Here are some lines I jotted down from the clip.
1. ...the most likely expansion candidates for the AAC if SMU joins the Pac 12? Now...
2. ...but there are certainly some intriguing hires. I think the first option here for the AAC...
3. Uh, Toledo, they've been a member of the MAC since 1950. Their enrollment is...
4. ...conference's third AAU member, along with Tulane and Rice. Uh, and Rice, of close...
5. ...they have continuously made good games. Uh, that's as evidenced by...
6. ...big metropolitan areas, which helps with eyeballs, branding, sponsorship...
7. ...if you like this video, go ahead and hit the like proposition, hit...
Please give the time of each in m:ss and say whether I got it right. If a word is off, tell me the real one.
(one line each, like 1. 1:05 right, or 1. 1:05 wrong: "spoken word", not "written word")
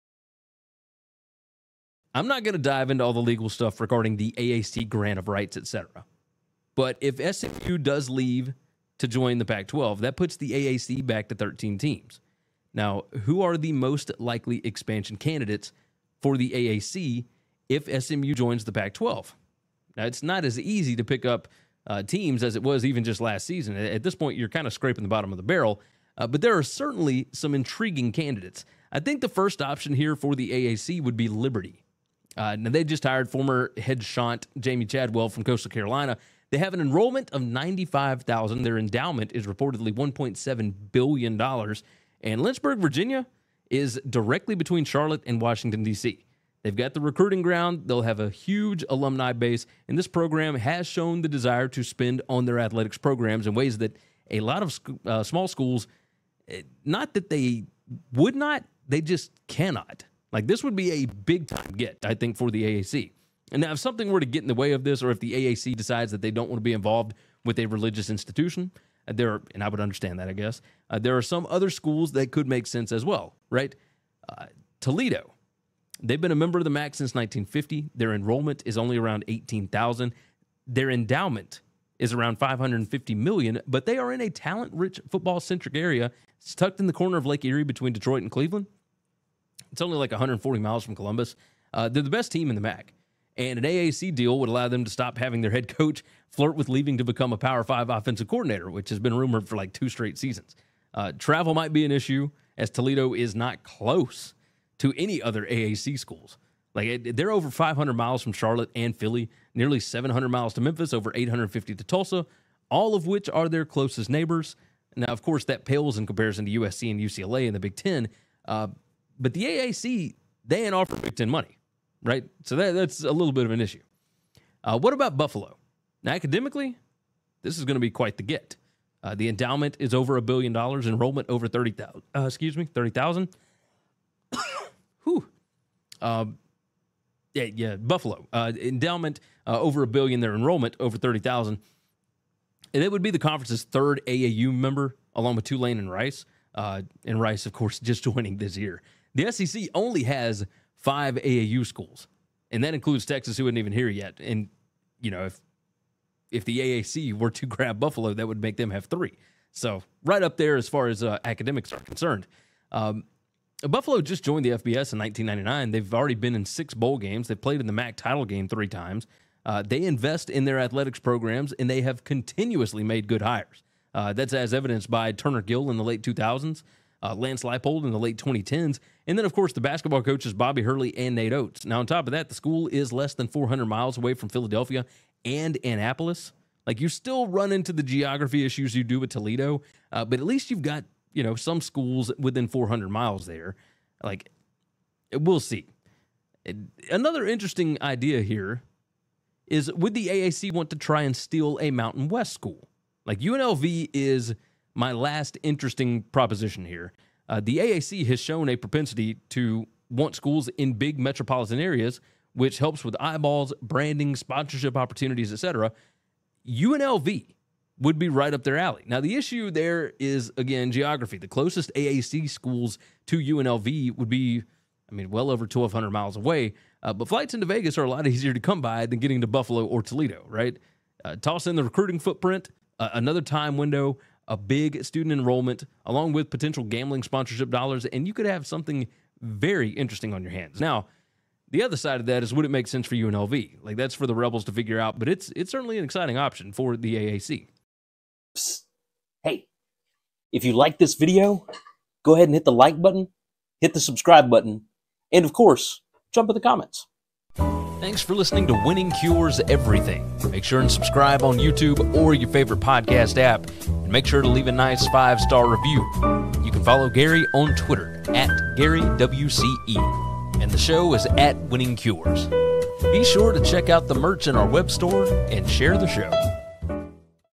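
1. 0:13 right
2. 0:26 wrong: "candidates", not "hires"
3. 1:14 right
4. 2:23 wrong: "course", not "close"
5. 2:51 wrong: "hires", not "games"
6. 3:30 right
7. 4:10 wrong: "button", not "proposition".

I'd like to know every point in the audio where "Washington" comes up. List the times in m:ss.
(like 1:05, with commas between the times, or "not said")
0:45.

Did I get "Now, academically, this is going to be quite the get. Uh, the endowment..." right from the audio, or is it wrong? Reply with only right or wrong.
right.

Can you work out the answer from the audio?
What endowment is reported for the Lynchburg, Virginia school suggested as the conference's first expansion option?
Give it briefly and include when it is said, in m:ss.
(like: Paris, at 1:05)
$1.7 billion, at 0:39.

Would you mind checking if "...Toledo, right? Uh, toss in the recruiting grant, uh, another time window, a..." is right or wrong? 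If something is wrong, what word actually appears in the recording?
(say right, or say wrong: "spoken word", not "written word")
wrong: "footprint", not "grant".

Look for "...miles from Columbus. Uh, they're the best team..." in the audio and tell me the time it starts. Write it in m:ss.
1:30.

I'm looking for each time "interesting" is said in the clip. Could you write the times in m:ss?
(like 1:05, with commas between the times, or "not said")
3:17, 3:25, 3:59.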